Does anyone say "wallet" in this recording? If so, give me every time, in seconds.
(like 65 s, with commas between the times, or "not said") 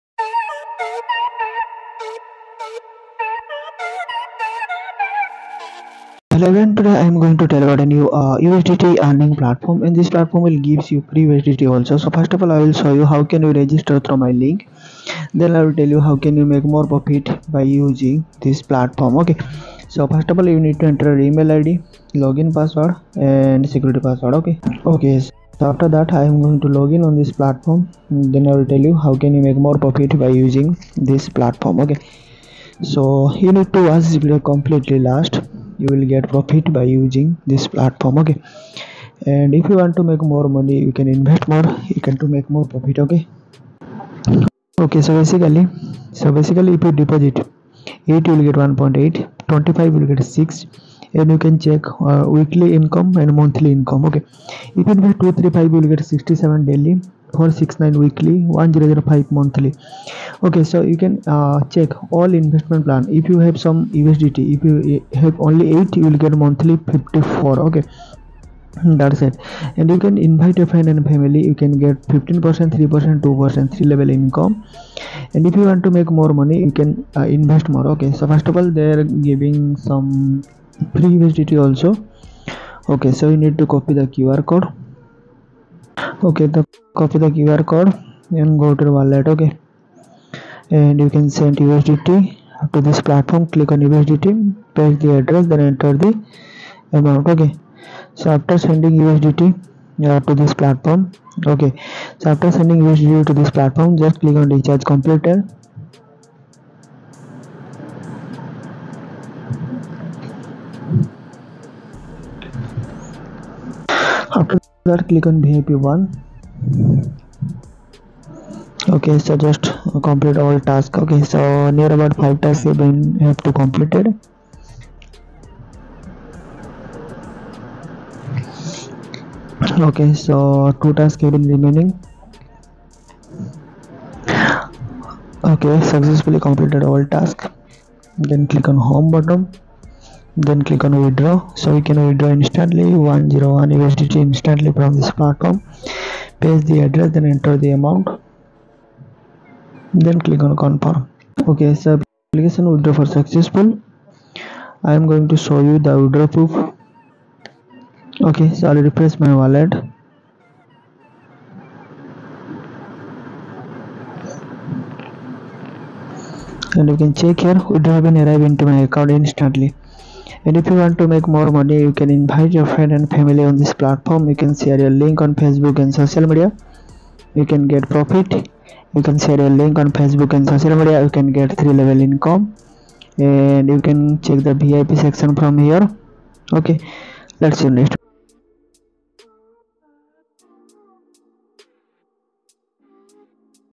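88 s, 159 s.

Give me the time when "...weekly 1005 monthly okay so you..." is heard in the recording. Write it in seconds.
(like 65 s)
58 s.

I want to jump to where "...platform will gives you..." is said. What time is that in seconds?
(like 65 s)
10 s.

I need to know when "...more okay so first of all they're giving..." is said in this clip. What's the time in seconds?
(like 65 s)
77 s.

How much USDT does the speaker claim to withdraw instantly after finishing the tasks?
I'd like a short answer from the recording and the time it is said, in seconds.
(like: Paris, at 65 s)
101 USDT, at 142 s.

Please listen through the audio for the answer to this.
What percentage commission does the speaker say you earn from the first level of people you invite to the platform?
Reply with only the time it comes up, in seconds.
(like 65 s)
72 s.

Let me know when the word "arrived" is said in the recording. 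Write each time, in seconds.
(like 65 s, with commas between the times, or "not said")
168 s.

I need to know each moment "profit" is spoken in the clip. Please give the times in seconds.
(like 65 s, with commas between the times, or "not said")
16 s, 29 s, 36 s, 42 s, 177 s.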